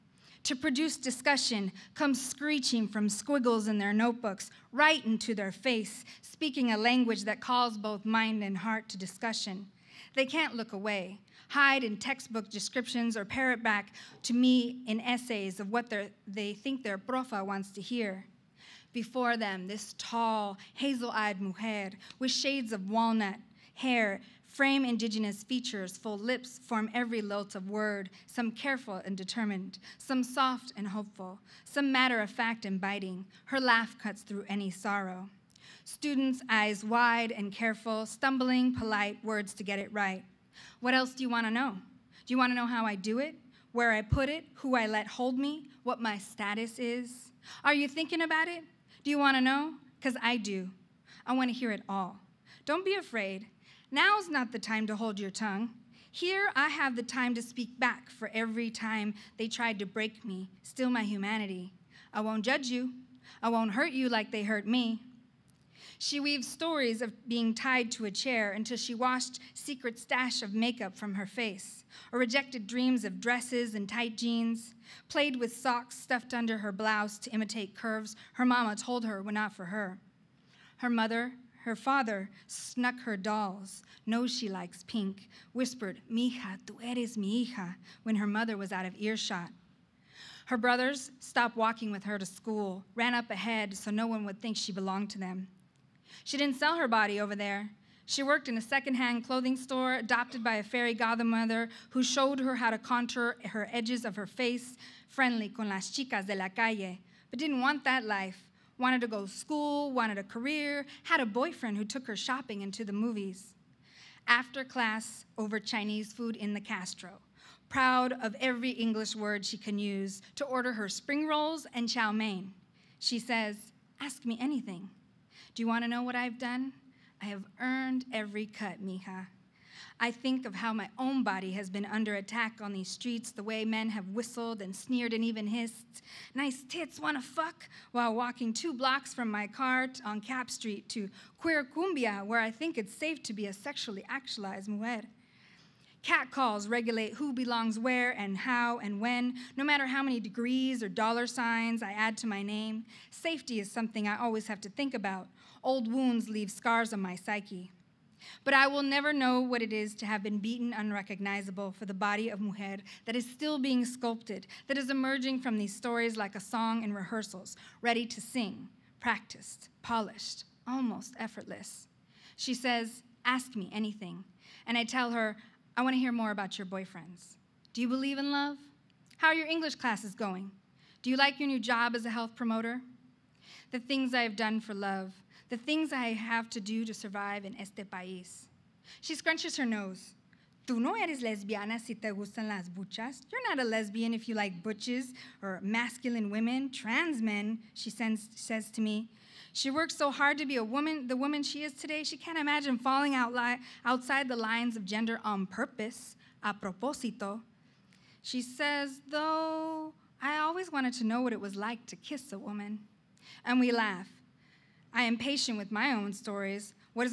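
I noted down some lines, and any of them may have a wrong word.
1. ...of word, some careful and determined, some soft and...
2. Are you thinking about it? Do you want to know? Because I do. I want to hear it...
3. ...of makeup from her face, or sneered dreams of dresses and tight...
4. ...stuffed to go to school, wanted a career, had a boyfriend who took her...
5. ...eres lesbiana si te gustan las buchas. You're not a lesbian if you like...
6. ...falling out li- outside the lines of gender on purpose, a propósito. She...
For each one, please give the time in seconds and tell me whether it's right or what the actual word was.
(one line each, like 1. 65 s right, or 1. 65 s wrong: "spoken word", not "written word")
1. 27 s right
2. 47 s right
3. 70 s wrong: "rejected", not "sneered"
4. 108 s wrong: "wanted", not "stuffed"
5. 190 s right
6. 202 s right.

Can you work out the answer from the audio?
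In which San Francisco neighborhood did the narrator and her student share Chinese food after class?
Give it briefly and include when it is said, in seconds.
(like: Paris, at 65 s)
the Castro, at 116 s.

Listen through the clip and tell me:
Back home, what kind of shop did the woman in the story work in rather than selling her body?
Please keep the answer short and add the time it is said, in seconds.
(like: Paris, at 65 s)
secondhand clothing store, at 98 s.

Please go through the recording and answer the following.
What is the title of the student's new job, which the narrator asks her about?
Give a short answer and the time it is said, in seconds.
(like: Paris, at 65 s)
health promoter, at 182 s.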